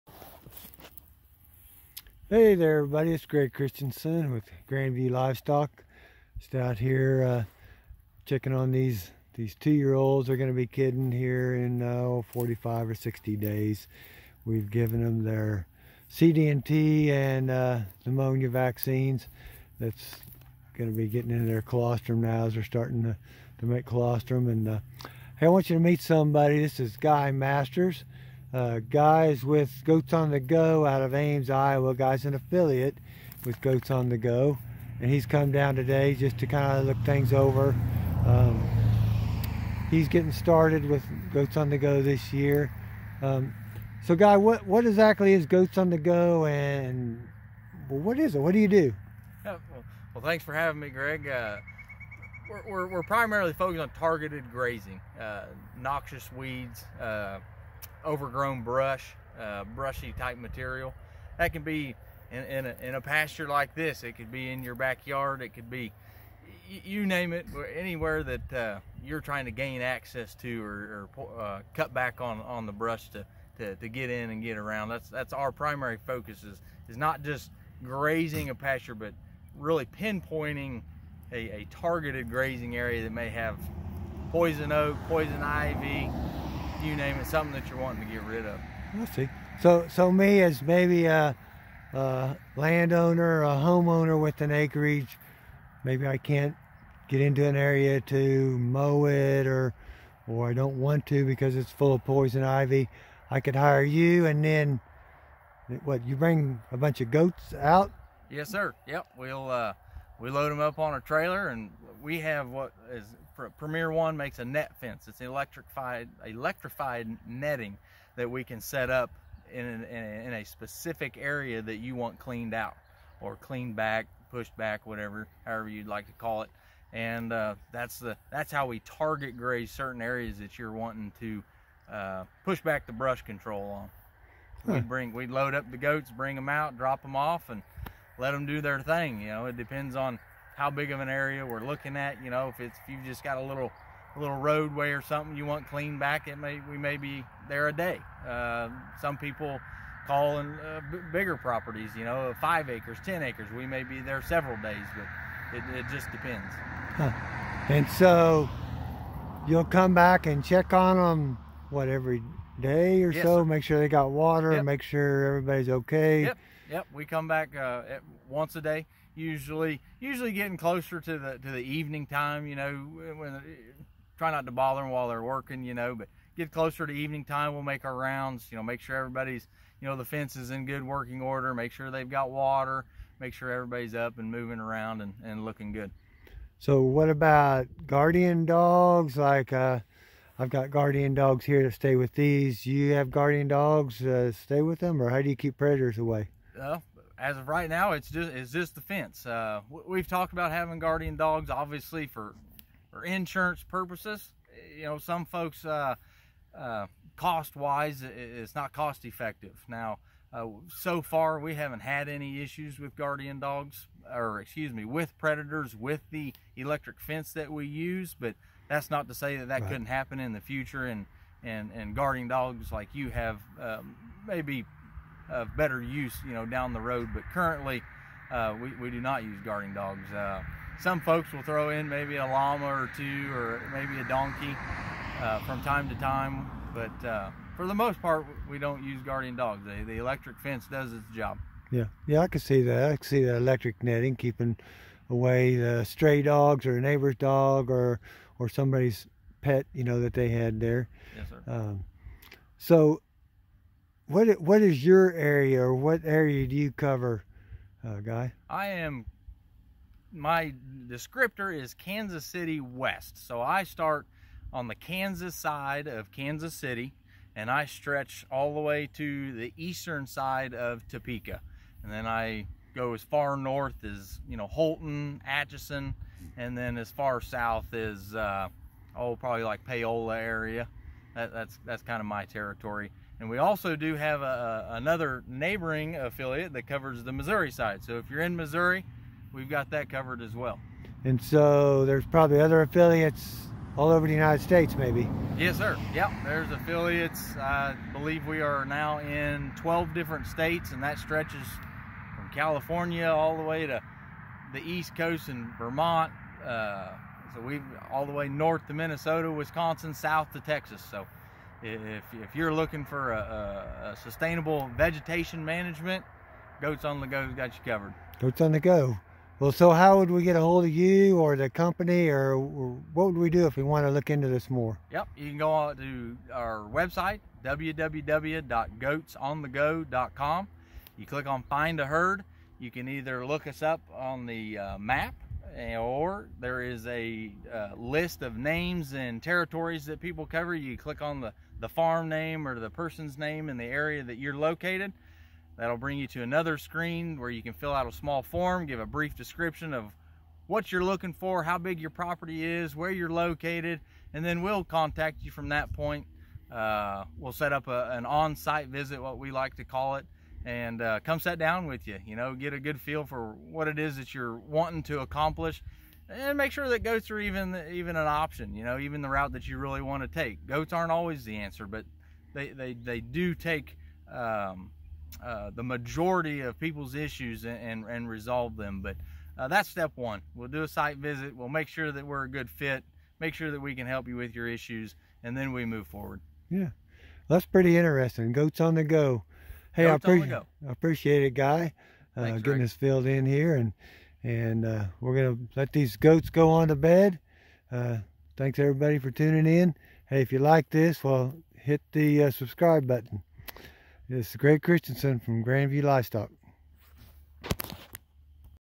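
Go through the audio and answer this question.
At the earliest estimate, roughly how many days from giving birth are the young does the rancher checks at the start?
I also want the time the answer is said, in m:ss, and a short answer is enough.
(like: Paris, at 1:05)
45, at 0:12.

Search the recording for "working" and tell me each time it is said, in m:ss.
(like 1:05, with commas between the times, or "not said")
2:55, 3:00.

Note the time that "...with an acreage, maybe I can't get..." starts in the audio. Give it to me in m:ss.
1:34.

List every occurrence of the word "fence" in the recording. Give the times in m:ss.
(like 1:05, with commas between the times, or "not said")
1:54, 3:00, 3:18, 3:37, 4:00.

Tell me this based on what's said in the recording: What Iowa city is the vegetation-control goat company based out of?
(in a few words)
Ames, Iowa.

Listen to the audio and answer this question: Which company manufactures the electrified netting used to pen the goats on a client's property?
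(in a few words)
Premier One.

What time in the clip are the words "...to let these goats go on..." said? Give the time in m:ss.
6:35.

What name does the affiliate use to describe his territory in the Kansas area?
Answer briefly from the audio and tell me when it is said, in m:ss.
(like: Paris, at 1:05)
Kansas City West, at 4:21.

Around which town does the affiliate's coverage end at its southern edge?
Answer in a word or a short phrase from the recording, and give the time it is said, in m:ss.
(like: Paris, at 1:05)
Paola, at 4:39.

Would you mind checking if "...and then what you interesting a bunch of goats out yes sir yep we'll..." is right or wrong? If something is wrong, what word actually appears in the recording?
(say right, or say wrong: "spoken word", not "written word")
wrong: "bring", not "interesting".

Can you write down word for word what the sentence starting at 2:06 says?
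And uh, that's the that's how we target graze certain areas that you're wanting to uh, push back the brush control on.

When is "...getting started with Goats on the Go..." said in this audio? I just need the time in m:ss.
0:40.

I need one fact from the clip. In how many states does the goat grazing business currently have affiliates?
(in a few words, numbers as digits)
12.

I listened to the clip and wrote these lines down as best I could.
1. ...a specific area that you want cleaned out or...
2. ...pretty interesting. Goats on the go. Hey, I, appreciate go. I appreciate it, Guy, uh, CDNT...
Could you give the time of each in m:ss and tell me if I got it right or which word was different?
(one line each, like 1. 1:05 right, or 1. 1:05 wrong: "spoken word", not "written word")
1. 2:00 right
2. 6:27 wrong: "Thanks", not "CDNT".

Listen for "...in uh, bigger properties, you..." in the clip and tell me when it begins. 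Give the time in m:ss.
2:30.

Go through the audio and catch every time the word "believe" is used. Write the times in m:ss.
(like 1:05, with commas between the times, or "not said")
4:57.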